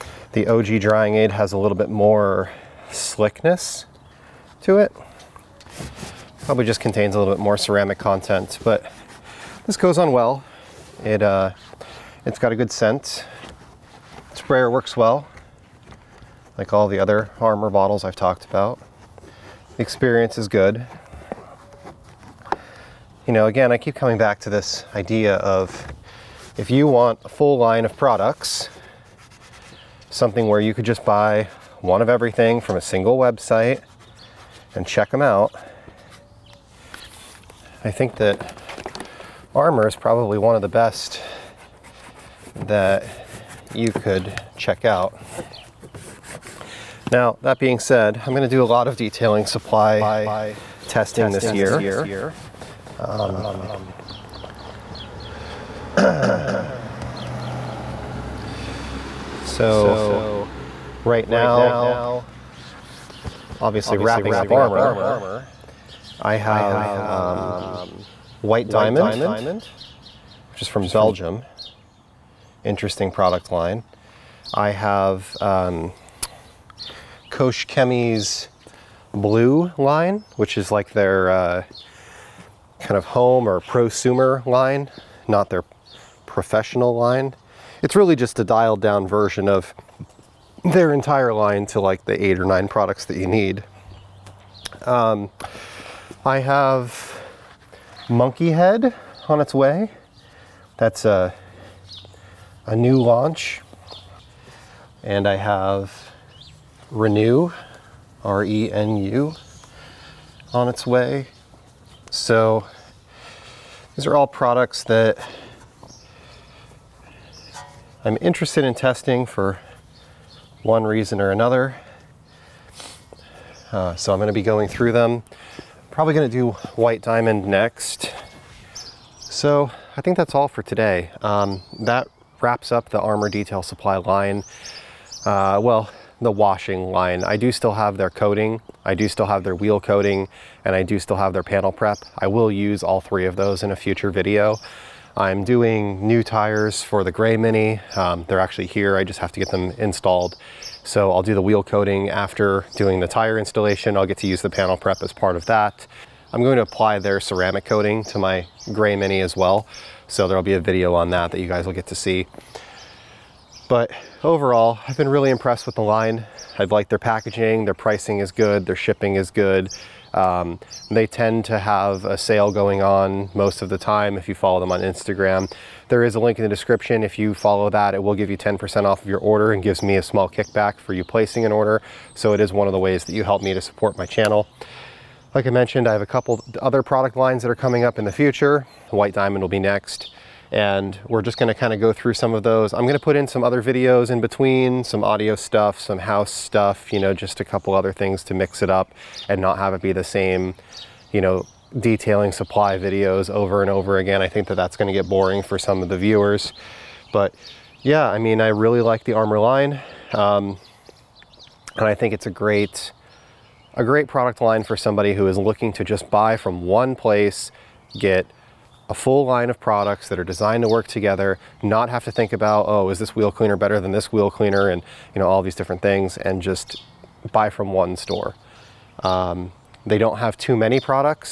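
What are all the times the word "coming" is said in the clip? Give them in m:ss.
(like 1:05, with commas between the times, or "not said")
0:23, 3:07.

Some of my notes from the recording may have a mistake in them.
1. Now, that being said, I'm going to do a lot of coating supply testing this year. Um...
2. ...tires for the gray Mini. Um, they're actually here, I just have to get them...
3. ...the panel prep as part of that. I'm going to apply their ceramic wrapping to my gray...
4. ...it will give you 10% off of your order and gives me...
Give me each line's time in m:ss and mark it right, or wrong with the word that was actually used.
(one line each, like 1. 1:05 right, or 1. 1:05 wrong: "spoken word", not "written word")
1. 0:47 wrong: "detailing", not "coating"
2. 2:26 right
3. 2:34 wrong: "coating", not "wrapping"
4. 2:57 right.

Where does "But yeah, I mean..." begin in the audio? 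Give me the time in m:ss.
3:27.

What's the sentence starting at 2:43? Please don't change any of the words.
But overall, I've been really impressed with the line.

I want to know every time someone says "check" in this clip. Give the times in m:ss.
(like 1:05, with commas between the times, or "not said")
0:34, 0:44.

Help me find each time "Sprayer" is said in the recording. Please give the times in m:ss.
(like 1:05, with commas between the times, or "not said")
0:14.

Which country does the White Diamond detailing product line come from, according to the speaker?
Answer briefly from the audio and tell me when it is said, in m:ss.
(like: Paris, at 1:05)
Belgium, at 1:10.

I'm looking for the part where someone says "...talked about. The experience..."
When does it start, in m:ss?
0:18.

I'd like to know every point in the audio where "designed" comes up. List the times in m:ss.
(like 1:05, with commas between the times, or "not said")
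3:40.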